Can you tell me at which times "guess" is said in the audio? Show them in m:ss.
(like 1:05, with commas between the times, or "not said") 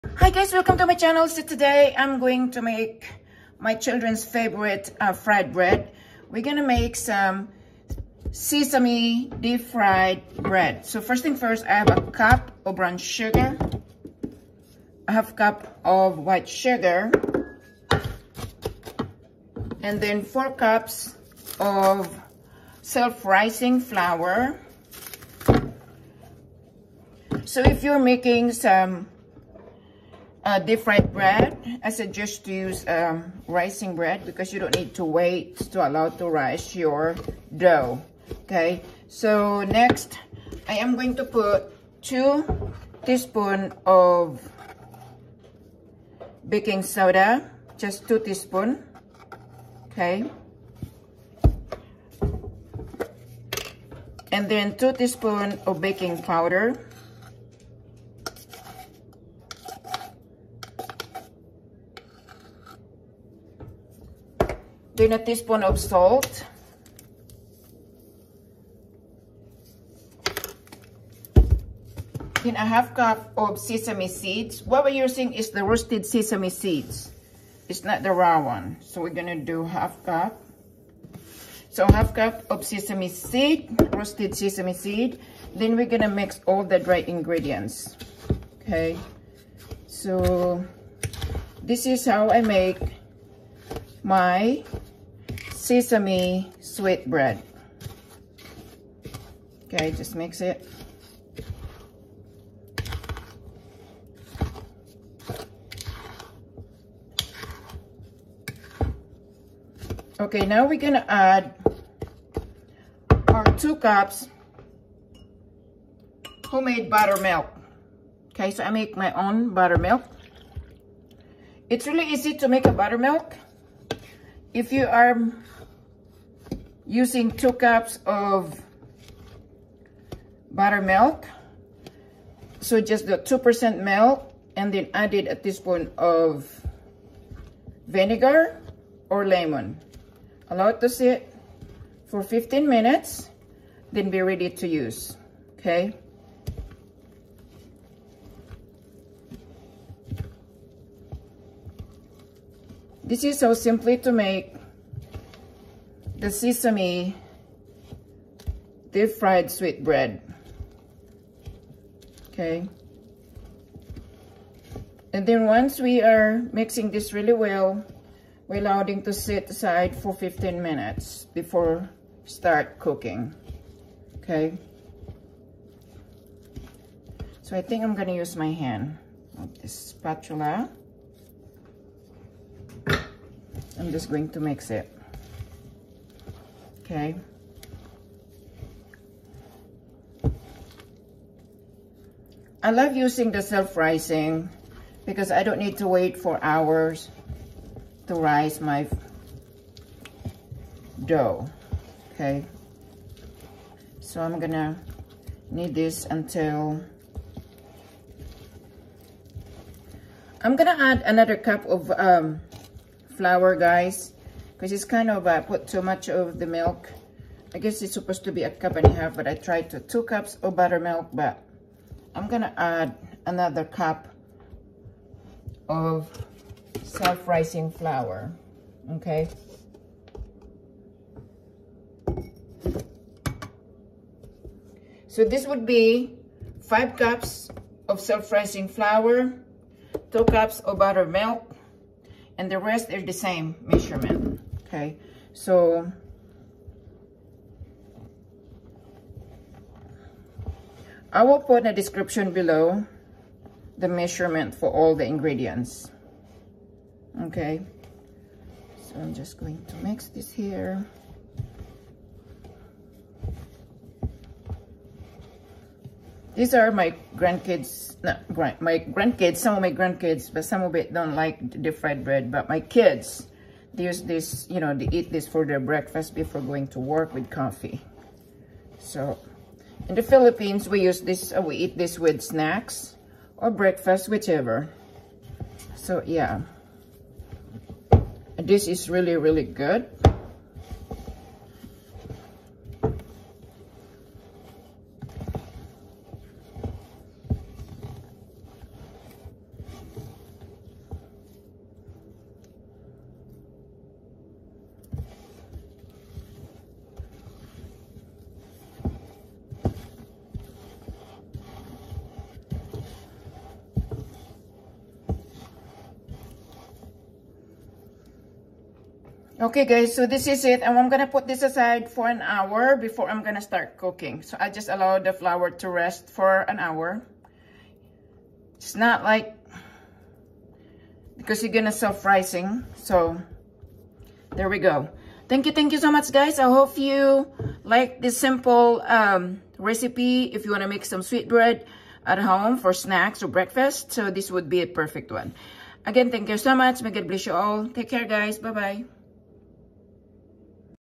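3:37.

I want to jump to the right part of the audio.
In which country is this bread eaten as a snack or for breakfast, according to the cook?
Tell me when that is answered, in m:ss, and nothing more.
4:40.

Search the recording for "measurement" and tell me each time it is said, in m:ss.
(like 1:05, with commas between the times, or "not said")
4:03, 4:13.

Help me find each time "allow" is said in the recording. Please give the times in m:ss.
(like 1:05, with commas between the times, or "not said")
0:35, 2:20, 2:48, 5:24.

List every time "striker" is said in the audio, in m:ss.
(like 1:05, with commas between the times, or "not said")
not said.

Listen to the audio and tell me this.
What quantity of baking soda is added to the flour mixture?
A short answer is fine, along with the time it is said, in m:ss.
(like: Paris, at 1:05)
2 teaspoons, at 0:42.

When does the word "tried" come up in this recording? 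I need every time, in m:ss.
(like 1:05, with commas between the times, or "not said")
3:39.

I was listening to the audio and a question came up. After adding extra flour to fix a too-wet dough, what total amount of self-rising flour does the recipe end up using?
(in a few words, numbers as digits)
5 cups.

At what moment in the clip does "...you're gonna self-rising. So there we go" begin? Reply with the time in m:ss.
5:31.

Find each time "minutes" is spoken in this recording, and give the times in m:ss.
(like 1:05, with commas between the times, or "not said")
2:22, 2:50.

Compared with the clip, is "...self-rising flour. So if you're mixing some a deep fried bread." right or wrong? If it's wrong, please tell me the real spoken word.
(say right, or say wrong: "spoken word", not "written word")
wrong: "making", not "mixing".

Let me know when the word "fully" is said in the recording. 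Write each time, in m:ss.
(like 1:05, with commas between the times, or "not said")
not said.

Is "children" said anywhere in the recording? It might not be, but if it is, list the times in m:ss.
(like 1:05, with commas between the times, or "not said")
0:03.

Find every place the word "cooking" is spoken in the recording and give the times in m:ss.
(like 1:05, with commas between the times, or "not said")
2:52, 5:23.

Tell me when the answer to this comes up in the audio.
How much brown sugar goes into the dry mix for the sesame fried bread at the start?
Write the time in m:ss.
0:11.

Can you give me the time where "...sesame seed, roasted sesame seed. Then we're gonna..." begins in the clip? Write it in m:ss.
1:22.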